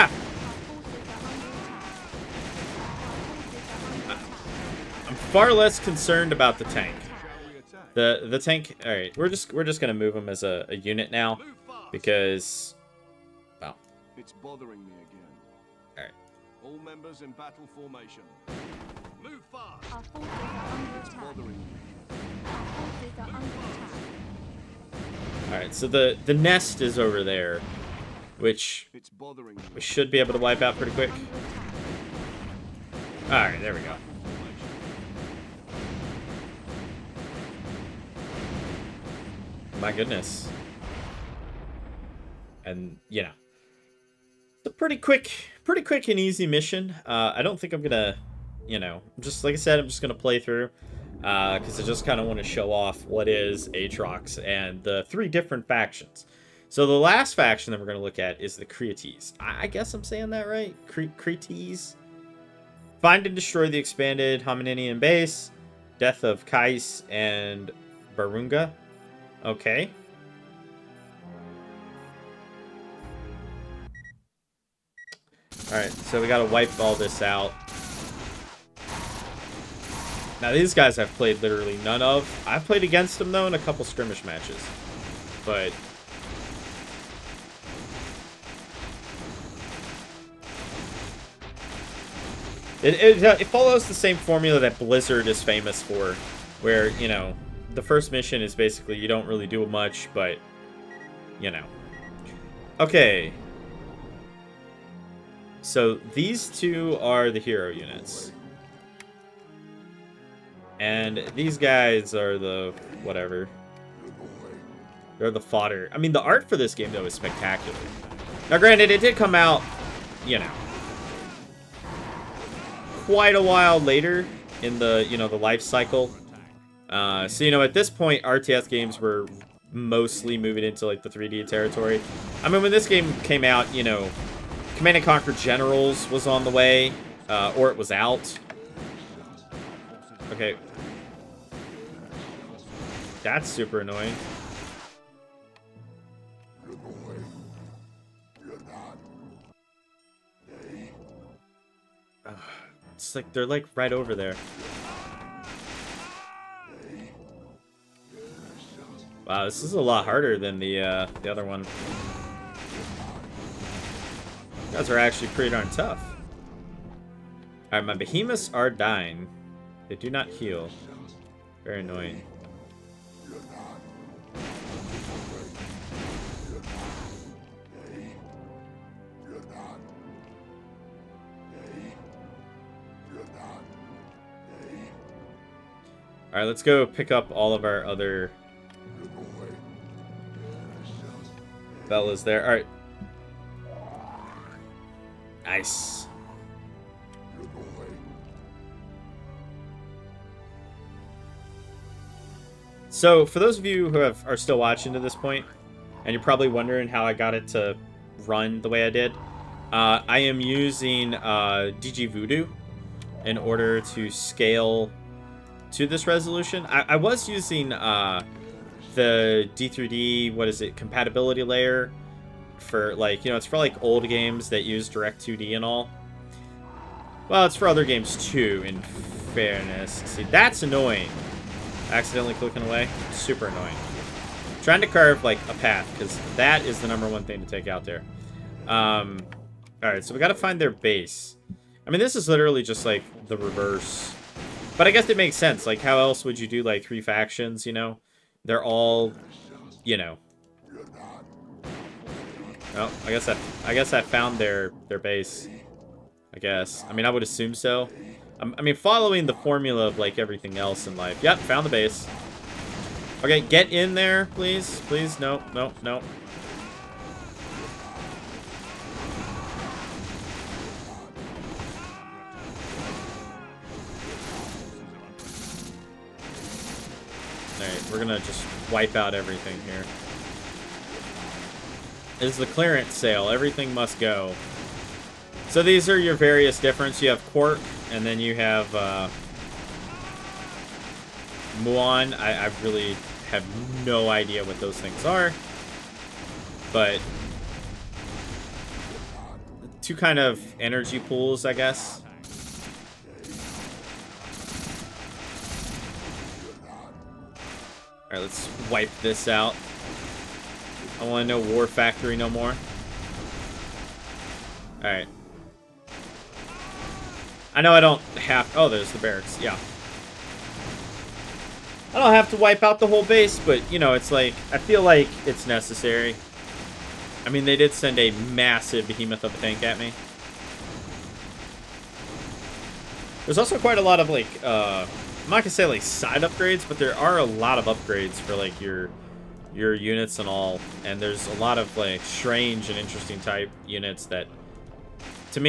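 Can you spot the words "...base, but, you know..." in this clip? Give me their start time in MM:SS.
05:23.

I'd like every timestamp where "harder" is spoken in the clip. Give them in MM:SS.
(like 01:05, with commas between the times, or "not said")
02:40.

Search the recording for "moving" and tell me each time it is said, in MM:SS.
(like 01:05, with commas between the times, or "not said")
02:10.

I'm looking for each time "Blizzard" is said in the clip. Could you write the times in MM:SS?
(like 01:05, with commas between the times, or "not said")
01:34.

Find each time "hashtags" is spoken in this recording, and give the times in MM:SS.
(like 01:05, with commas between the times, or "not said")
not said.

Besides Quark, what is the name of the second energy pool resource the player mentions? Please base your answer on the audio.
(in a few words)
Muon.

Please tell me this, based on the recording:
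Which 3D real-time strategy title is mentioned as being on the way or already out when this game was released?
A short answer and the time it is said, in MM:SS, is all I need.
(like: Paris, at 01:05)
Command and Conquer Generals, at 02:14.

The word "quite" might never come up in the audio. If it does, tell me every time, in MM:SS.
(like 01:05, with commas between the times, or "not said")
02:03, 05:33.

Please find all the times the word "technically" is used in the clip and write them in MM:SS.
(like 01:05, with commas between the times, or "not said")
not said.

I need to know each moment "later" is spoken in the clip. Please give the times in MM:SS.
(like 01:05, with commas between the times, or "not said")
02:03.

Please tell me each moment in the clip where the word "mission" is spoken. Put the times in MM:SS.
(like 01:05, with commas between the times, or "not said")
00:46, 01:38.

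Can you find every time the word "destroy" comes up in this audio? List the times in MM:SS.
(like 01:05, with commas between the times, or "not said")
01:03.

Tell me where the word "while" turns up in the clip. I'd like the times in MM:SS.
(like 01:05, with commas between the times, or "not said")
02:03.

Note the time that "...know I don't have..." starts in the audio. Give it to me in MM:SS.
05:17.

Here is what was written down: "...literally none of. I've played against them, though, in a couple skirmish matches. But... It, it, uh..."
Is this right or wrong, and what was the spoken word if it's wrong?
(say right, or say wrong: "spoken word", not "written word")
right.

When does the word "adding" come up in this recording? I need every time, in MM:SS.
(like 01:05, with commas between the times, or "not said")
not said.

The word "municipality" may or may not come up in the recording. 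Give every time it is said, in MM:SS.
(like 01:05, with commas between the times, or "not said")
not said.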